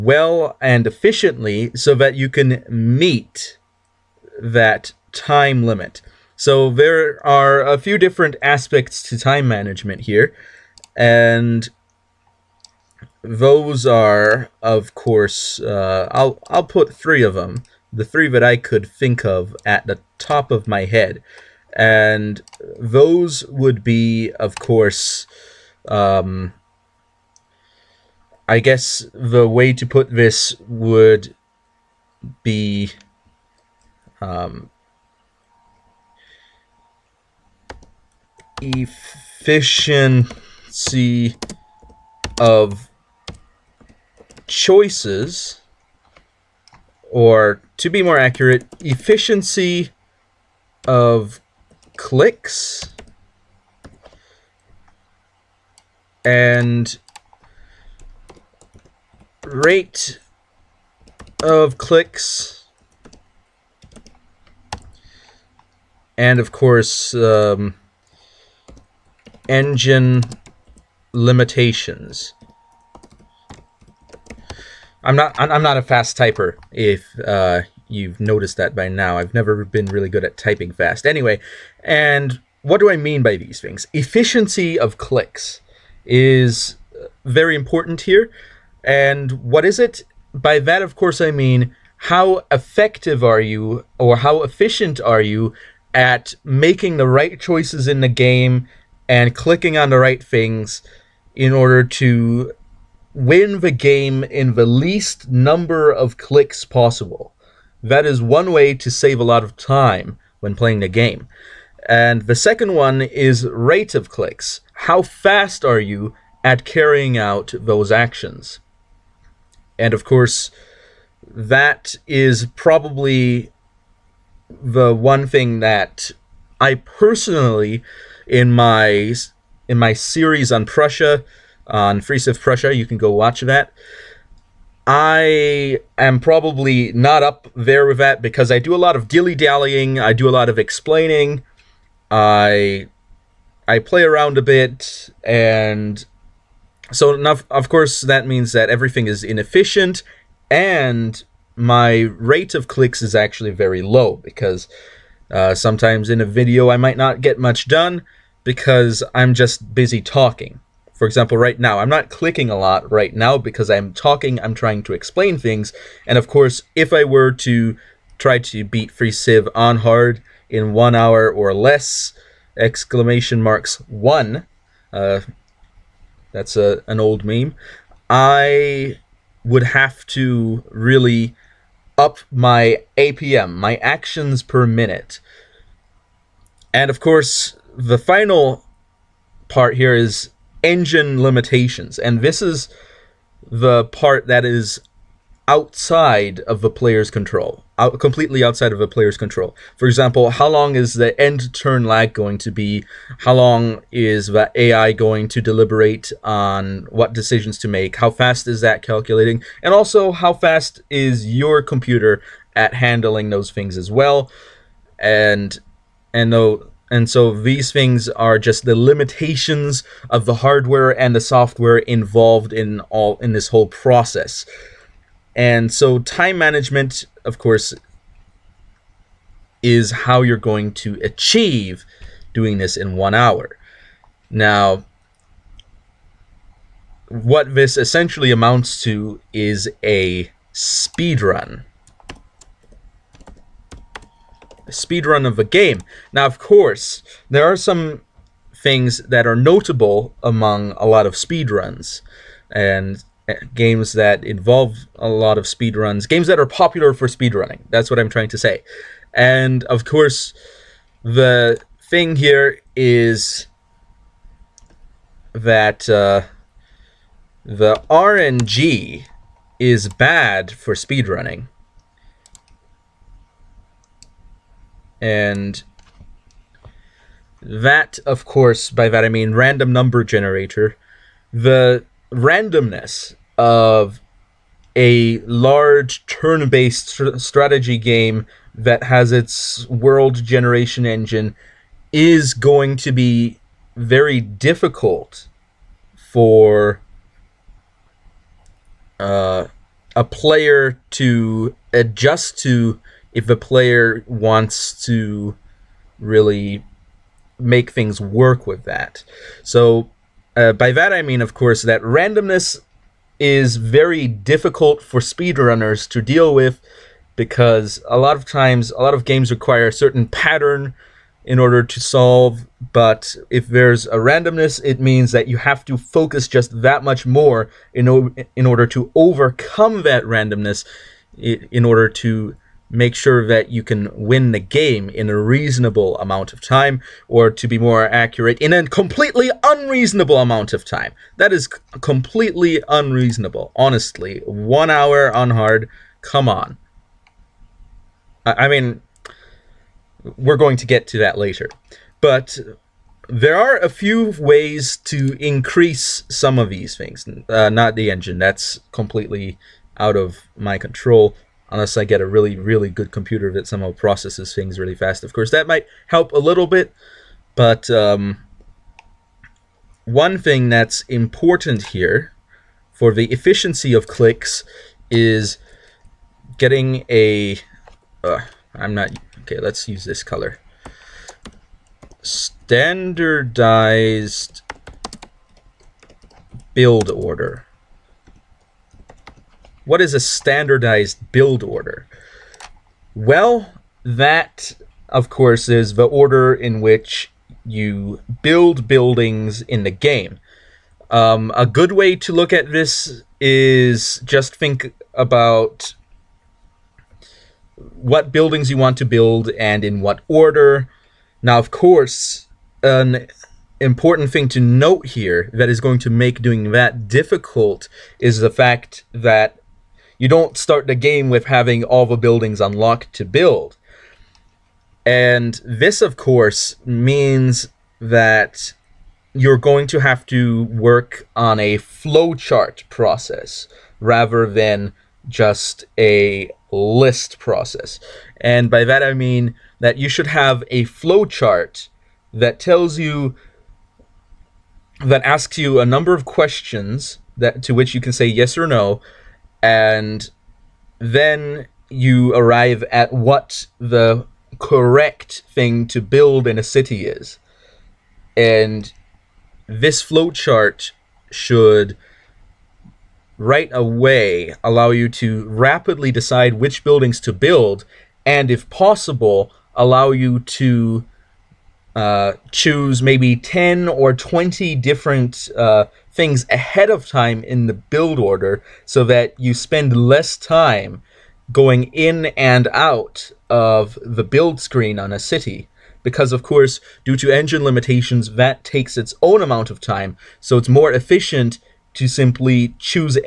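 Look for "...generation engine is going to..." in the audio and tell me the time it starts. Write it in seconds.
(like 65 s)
290 s.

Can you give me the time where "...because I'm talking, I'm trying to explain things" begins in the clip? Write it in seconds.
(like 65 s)
163 s.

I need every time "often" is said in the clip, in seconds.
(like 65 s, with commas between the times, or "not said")
not said.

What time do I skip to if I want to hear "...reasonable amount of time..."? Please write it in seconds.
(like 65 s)
335 s.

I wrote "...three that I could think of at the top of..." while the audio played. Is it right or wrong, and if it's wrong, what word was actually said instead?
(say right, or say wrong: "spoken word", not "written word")
right.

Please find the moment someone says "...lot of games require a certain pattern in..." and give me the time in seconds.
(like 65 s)
318 s.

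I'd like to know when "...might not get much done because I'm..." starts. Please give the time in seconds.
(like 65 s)
156 s.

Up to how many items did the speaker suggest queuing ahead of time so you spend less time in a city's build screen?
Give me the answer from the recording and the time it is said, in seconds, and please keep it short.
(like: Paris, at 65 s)
20, at 473 s.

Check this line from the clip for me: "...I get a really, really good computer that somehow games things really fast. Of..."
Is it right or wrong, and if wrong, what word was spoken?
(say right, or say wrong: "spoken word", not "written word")
wrong: "processes", not "games".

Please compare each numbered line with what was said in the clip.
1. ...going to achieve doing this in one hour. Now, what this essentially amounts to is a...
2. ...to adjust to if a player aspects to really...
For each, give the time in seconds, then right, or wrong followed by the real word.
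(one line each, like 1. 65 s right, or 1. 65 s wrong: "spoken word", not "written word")
1. 230 s right
2. 300 s wrong: "wants", not "aspects".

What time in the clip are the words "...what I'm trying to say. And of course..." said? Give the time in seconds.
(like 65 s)
257 s.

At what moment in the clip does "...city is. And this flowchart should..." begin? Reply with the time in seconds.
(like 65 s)
456 s.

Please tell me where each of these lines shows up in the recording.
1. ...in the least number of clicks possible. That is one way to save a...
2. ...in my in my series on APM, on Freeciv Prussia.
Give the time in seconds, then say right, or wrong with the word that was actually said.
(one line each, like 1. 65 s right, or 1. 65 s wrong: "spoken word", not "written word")
1. 104 s right
2. 128 s wrong: "Prussia", not "APM".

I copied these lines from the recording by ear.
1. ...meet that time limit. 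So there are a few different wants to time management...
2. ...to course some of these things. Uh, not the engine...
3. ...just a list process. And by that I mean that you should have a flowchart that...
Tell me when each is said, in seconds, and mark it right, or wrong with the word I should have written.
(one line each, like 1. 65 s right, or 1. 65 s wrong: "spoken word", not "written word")
1. 2 s wrong: "aspects", not "wants"
2. 354 s wrong: "increase", not "course"
3. 435 s right.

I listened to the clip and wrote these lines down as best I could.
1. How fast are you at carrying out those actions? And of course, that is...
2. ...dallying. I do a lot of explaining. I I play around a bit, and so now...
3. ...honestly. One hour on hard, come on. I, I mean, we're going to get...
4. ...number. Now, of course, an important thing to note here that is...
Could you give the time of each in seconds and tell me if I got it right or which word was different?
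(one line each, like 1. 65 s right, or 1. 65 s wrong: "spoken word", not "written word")
1. 114 s right
2. 139 s right
3. 343 s right
4. 410 s wrong: "order", not "number".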